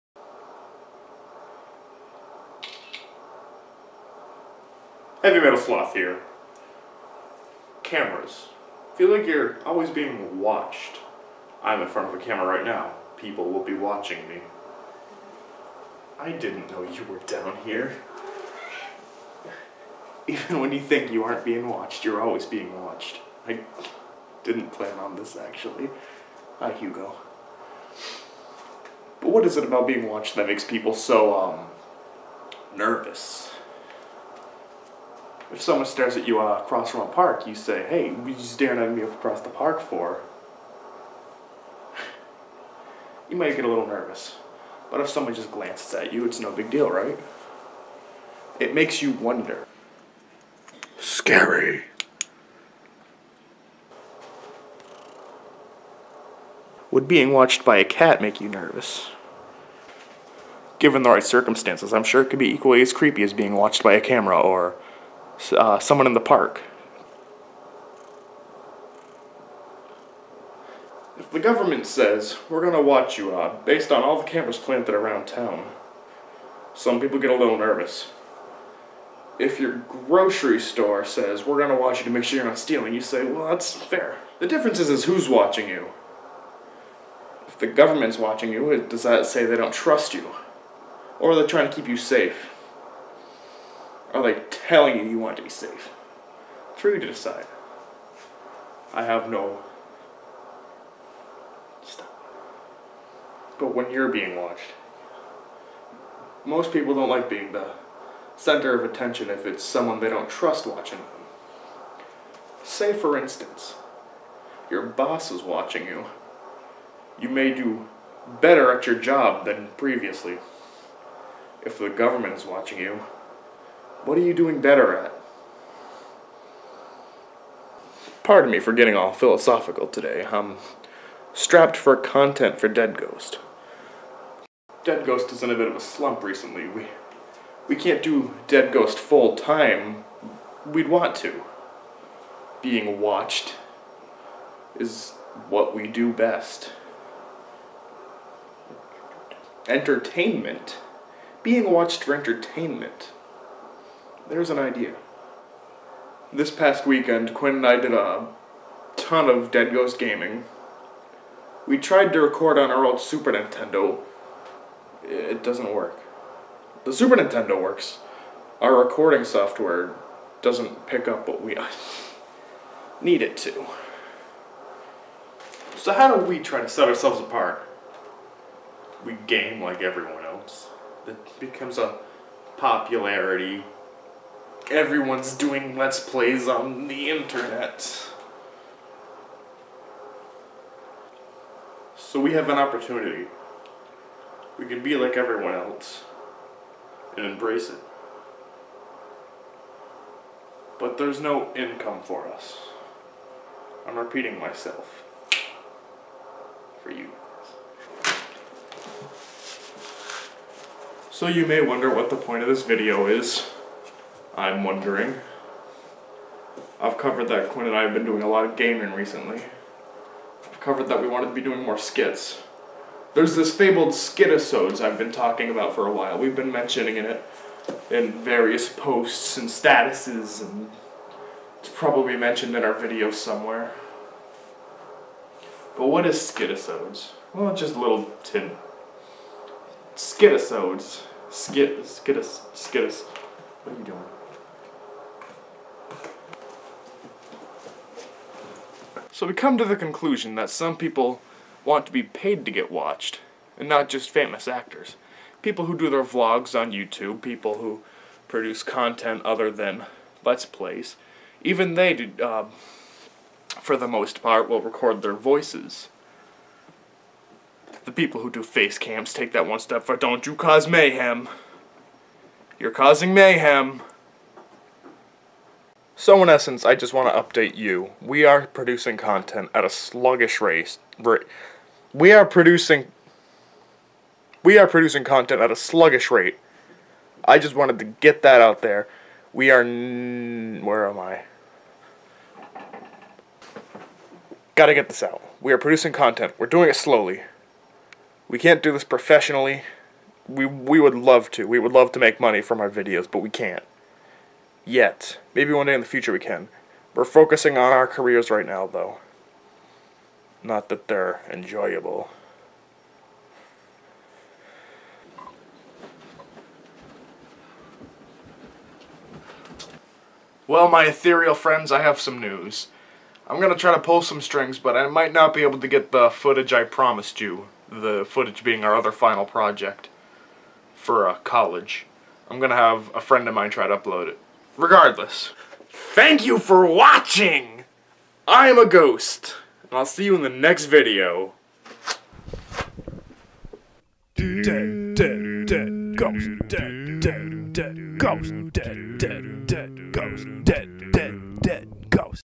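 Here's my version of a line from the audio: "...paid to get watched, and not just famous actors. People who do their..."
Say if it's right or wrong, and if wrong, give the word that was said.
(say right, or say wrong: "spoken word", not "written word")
right.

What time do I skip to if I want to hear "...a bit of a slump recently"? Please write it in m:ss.
2:15.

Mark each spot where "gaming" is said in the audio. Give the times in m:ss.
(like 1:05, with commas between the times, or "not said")
2:39, 3:38.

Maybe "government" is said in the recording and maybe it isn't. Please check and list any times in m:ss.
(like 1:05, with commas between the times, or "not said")
1:11, 1:27, 2:01.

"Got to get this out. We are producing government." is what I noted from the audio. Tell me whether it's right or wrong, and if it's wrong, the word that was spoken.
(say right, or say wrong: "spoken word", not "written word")
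wrong: "content", not "government".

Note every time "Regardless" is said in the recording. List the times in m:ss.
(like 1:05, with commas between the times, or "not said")
5:34.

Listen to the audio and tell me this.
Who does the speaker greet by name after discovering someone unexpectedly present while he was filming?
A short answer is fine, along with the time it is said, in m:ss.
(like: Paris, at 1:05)
Hugo, at 0:26.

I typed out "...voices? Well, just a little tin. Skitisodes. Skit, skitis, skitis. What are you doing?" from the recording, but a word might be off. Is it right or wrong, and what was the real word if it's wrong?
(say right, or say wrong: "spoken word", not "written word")
wrong: "skitisodes", not "voices".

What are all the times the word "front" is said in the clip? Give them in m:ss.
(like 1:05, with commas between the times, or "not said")
0:11.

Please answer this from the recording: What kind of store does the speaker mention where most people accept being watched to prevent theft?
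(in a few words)
grocery store.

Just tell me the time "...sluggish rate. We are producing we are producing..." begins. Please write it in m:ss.
4:39.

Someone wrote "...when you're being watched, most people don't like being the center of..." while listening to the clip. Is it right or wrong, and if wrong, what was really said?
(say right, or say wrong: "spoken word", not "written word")
right.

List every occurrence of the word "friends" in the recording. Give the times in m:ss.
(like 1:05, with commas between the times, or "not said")
5:21, 5:33.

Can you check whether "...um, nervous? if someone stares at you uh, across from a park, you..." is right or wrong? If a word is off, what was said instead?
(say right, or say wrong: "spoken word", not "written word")
right.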